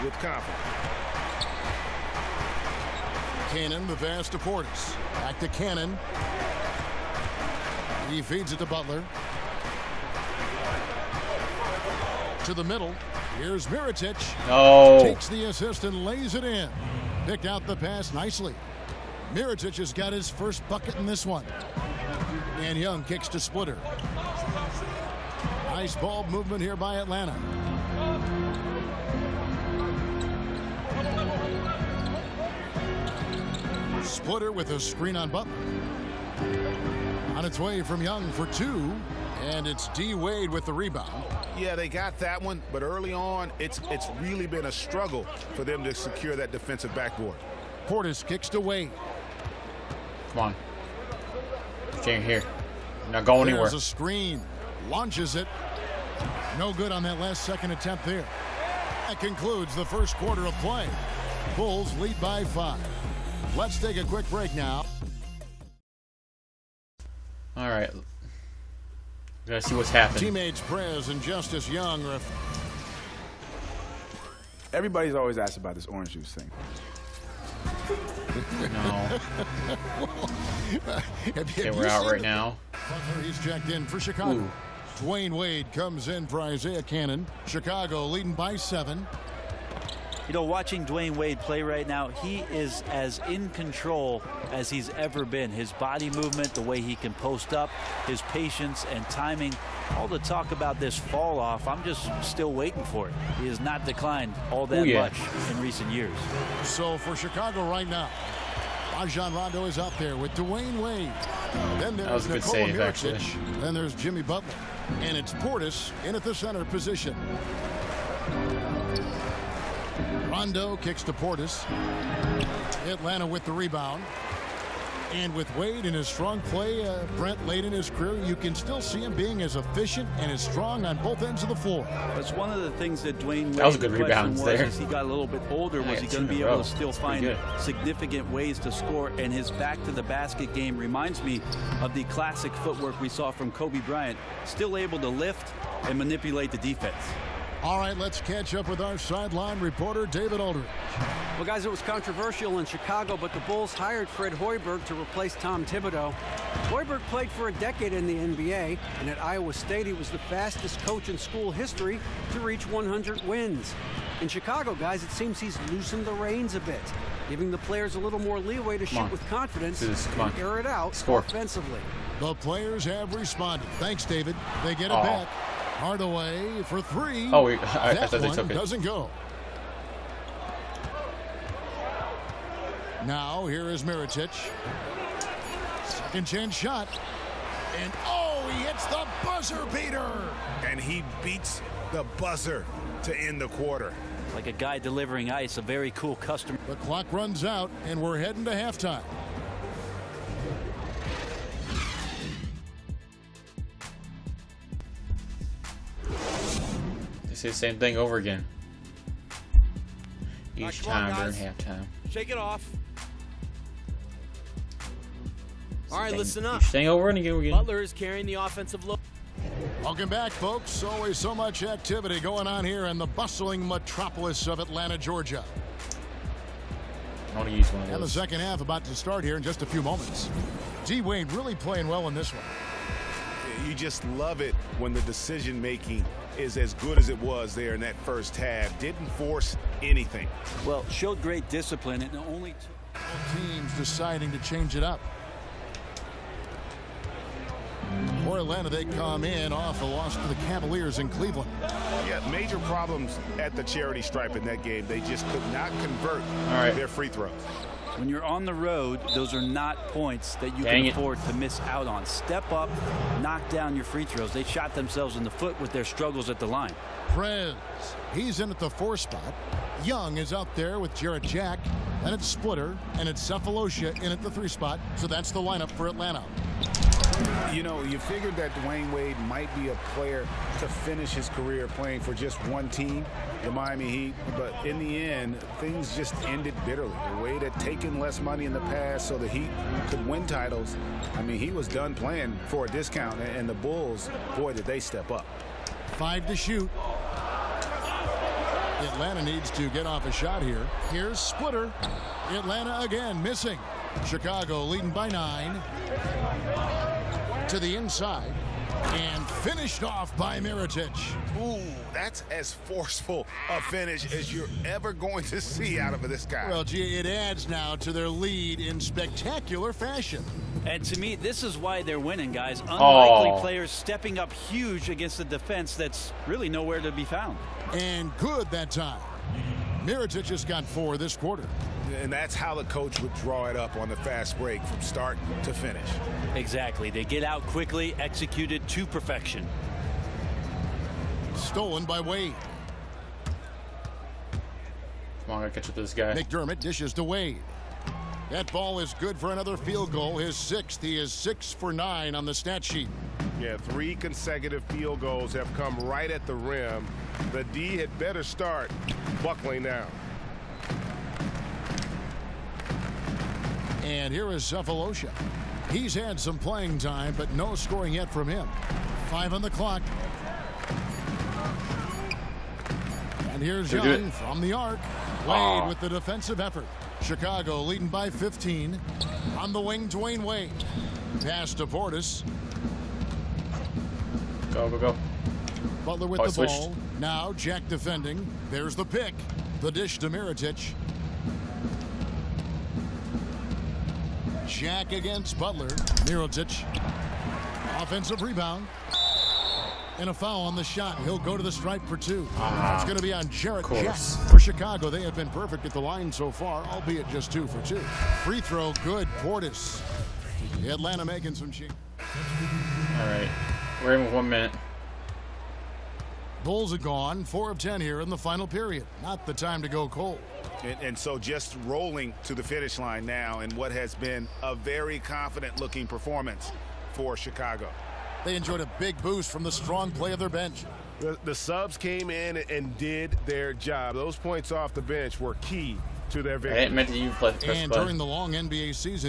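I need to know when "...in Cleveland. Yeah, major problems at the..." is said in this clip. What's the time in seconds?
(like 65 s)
250 s.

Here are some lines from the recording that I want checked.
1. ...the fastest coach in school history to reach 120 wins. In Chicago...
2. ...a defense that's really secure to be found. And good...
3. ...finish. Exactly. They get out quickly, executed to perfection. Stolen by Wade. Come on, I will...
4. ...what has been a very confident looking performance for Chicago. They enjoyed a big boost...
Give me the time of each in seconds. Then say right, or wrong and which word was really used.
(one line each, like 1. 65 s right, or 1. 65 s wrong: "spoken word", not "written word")
1. 160 s wrong: "100", not "120"
2. 325 s wrong: "nowhere", not "secure"
3. 335 s right
4. 423 s right.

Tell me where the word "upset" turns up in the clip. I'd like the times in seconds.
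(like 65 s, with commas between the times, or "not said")
not said.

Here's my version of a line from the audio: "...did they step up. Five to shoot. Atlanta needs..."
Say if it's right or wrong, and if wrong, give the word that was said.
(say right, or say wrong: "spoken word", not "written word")
right.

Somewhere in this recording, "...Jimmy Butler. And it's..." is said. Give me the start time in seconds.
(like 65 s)
113 s.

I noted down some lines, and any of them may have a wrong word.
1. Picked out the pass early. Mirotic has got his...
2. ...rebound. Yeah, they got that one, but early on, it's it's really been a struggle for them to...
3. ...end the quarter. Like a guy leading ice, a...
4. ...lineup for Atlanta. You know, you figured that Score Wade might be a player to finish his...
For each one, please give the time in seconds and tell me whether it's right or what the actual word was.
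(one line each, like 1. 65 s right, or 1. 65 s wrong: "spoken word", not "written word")
1. 17 s wrong: "nicely", not "early"
2. 40 s right
3. 193 s wrong: "delivering", not "leading"
4. 275 s wrong: "Dwyane", not "Score".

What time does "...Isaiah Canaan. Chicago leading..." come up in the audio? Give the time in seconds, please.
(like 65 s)
86 s.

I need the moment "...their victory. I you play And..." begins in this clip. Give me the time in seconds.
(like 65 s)
436 s.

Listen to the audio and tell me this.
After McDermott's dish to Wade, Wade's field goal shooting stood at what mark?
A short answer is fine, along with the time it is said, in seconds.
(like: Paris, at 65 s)
6 for 9, at 351 s.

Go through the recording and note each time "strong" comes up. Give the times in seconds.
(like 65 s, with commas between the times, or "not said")
126 s, 130 s, 429 s.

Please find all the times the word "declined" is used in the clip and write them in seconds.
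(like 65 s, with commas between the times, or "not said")
103 s.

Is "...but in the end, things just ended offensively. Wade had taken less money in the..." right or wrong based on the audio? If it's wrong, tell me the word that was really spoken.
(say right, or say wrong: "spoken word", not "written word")
wrong: "bitterly", not "offensively".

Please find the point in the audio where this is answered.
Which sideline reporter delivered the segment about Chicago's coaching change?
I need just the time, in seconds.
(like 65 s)
150 s.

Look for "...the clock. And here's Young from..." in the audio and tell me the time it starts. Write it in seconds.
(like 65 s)
369 s.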